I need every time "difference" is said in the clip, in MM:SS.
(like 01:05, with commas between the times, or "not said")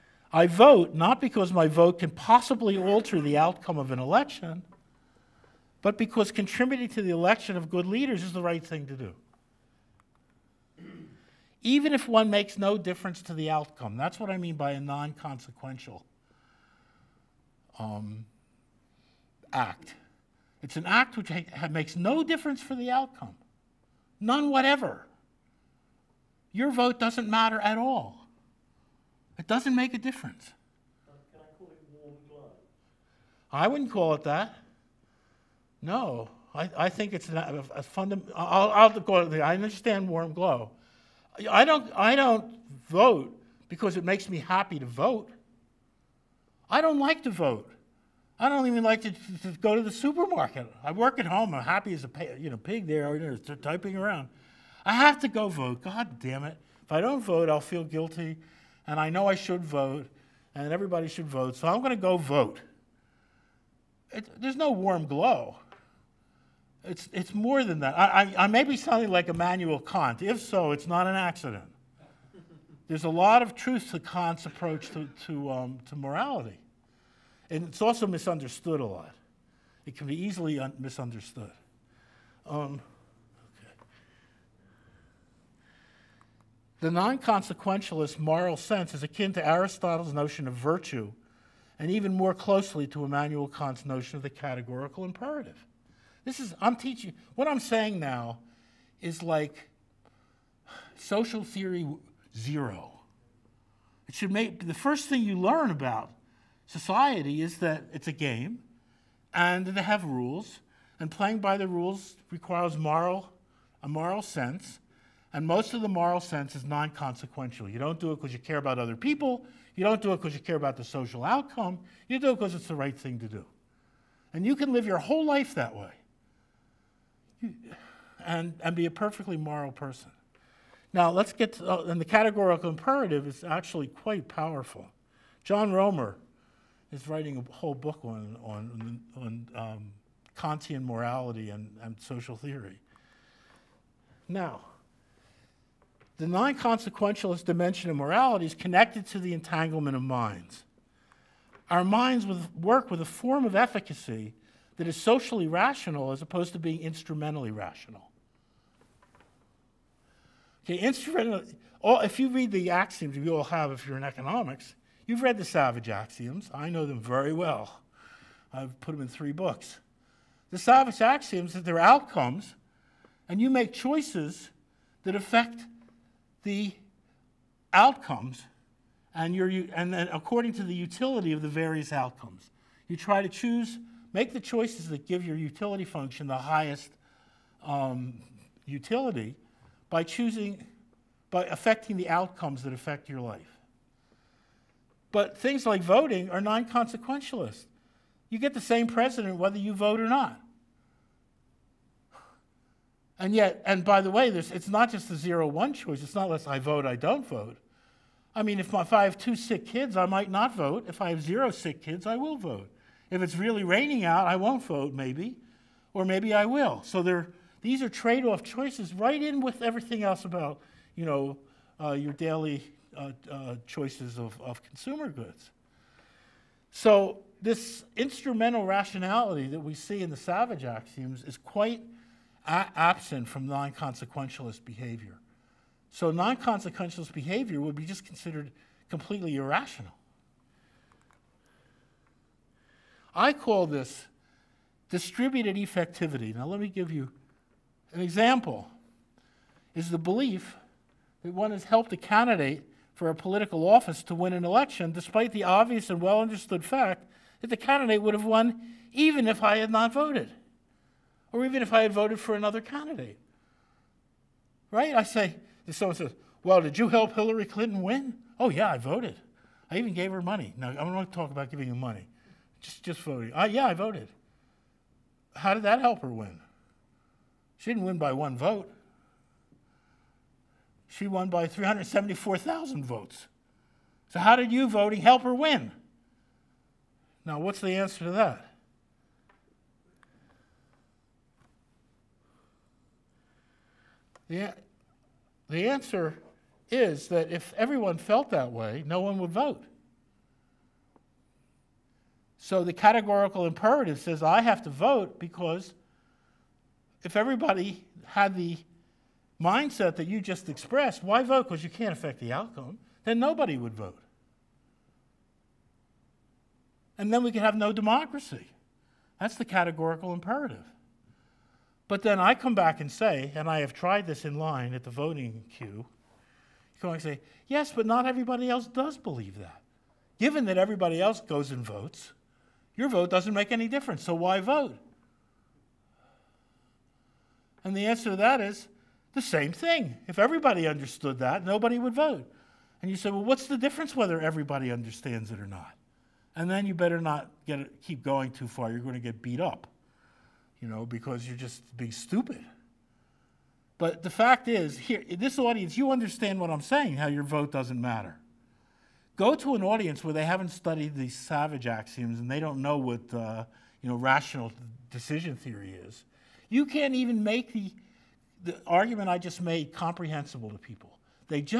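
00:12, 00:22, 00:29, 05:33, 05:43.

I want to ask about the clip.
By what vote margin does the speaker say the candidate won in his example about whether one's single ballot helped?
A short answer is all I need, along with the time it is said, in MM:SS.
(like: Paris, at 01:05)
374,000 votes, at 04:41.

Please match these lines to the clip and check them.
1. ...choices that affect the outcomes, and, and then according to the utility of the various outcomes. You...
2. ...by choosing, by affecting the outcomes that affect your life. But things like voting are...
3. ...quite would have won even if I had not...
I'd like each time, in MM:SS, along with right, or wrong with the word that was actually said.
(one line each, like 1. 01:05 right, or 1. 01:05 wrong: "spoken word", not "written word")
1. 02:53 right
2. 03:09 right
3. 04:17 wrong: "candidate", not "quite".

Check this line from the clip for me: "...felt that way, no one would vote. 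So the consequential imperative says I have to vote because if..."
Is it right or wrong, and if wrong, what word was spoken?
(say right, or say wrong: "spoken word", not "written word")
wrong: "categorical", not "consequential".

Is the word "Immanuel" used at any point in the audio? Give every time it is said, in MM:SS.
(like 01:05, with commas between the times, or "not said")
01:09, 01:33.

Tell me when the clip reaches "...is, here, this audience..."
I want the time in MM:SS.
05:54.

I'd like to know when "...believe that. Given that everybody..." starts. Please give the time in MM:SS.
05:28.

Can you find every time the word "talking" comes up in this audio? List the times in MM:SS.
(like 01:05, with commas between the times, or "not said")
04:31.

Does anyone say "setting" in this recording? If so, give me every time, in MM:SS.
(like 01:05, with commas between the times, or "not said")
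not said.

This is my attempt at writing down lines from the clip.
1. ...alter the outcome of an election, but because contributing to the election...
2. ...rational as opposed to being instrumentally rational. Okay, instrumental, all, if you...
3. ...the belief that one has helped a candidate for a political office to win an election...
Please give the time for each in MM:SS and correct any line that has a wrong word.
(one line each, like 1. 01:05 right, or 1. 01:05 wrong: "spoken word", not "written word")
1. 00:02 right
2. 02:35 right
3. 04:09 right.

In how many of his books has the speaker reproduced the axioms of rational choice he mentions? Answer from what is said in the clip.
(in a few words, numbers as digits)
3.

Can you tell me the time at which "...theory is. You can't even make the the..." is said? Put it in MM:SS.
06:05.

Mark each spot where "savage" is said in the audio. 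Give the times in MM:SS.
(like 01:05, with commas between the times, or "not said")
02:45, 02:50, 03:50, 06:01.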